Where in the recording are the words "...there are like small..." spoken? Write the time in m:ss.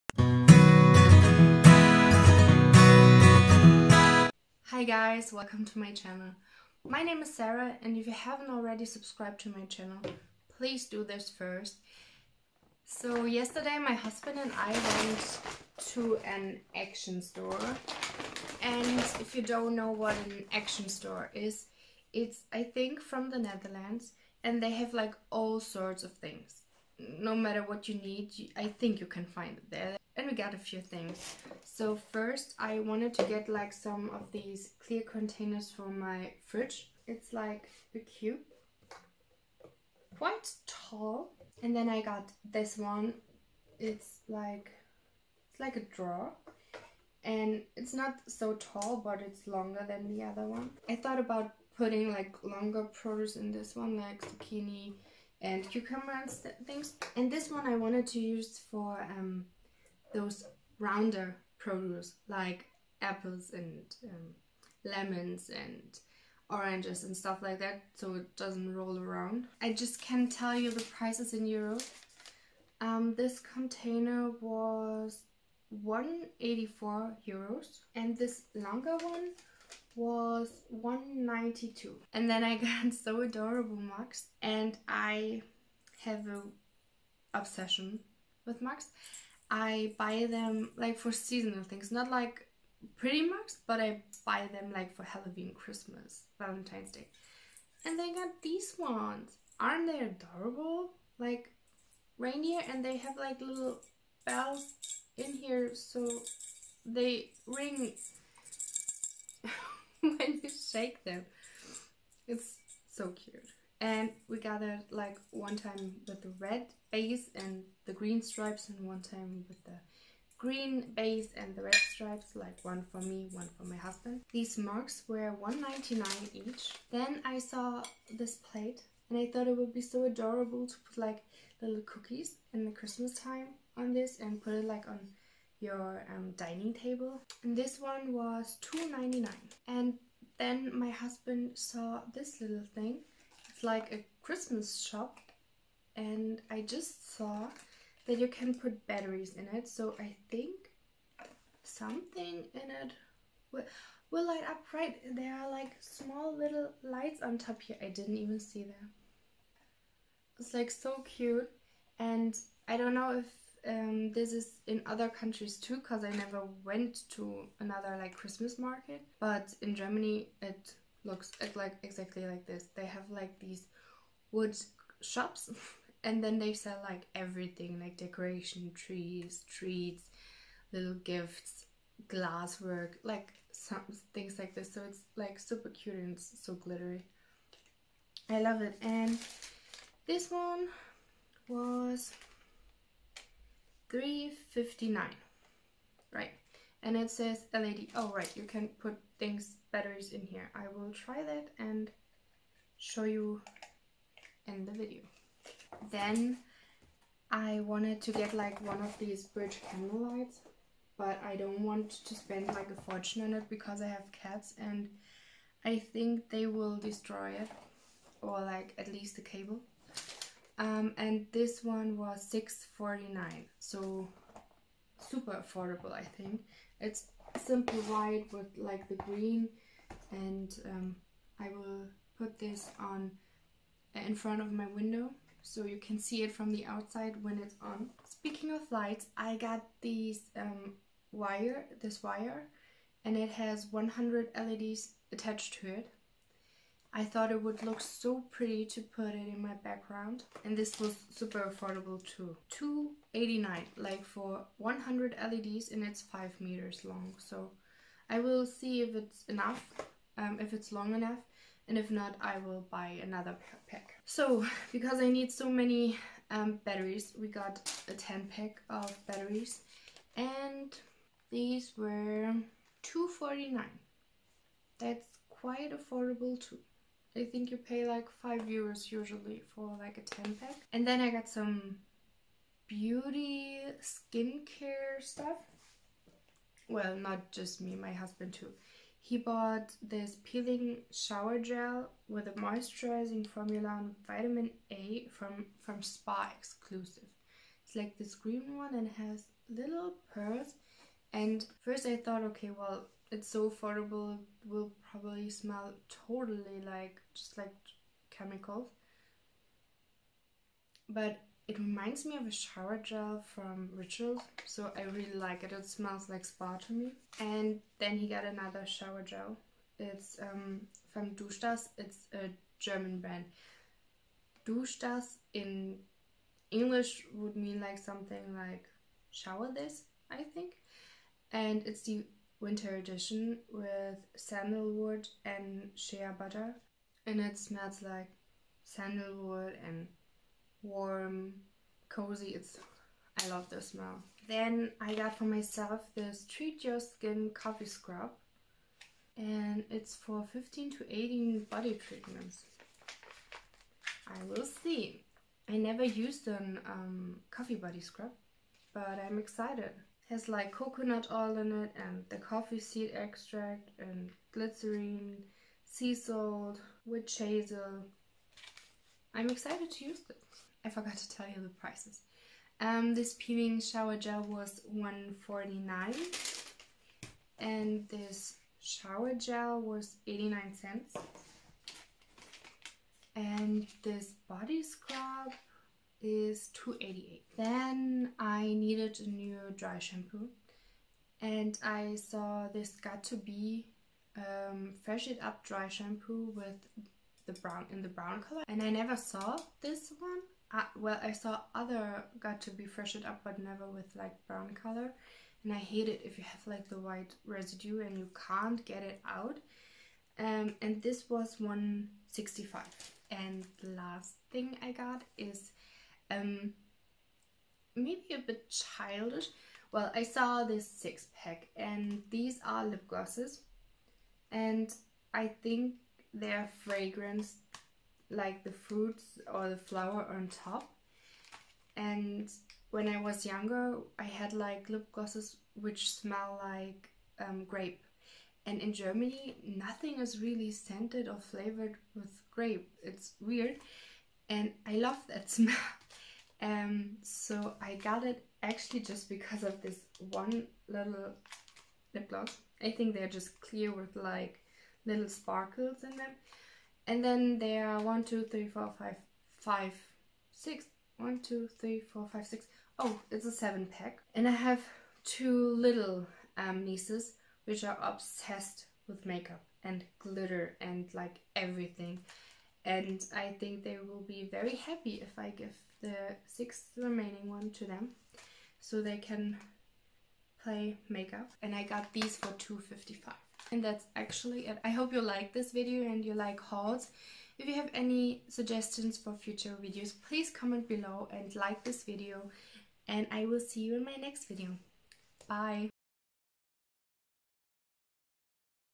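2:35.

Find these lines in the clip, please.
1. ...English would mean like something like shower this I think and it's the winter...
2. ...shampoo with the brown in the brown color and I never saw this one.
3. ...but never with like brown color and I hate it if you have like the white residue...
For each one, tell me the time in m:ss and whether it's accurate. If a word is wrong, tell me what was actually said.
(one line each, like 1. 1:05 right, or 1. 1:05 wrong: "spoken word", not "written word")
1. 5:26 right
2. 6:35 right
3. 6:43 right.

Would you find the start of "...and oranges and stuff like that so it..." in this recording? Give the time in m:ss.
1:05.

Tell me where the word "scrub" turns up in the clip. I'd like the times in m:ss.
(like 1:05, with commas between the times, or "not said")
5:47, 5:57, 6:24.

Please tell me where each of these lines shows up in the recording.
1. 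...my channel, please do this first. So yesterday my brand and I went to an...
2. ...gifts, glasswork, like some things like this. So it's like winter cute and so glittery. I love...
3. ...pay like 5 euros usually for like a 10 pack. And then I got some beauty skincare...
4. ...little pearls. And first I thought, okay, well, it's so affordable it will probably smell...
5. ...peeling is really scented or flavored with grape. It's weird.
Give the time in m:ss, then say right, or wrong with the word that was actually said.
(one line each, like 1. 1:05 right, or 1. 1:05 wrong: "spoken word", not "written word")
1. 0:09 wrong: "husband", not "brand"
2. 3:01 wrong: "super", not "winter"
3. 4:37 right
4. 4:59 right
5. 7:19 wrong: "nothing", not "peeling".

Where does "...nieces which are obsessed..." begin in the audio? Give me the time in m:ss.
7:46.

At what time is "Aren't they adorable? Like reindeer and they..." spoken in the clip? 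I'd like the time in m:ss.
1:39.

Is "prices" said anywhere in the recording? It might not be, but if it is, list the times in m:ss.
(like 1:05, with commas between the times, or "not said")
1:10, 6:11.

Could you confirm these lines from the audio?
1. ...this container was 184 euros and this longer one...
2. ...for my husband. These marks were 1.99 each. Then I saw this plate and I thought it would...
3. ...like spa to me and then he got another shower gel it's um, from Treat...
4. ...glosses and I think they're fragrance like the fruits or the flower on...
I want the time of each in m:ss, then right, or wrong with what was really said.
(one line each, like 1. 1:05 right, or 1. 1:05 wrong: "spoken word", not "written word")
1. 1:13 right
2. 2:03 right
3. 5:16 wrong: "Duschdas", not "Treat"
4. 7:02 right.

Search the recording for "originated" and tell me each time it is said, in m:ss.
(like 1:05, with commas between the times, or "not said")
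not said.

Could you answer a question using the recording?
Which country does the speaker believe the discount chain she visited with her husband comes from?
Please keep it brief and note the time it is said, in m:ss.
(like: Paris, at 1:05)
Netherlands, at 0:23.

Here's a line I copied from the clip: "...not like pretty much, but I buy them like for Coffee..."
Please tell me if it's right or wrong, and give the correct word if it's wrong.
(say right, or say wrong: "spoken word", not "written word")
wrong: "Halloween", not "Coffee".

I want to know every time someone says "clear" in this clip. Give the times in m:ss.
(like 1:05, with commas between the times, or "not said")
0:34, 7:33.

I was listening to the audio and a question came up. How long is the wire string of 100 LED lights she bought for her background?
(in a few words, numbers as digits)
5 meters.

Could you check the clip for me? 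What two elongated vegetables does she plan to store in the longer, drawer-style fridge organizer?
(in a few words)
zucchini and cucumber.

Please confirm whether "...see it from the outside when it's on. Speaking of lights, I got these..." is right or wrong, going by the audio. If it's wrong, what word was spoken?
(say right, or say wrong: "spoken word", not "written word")
right.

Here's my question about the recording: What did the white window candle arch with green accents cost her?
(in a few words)
6.49 euros.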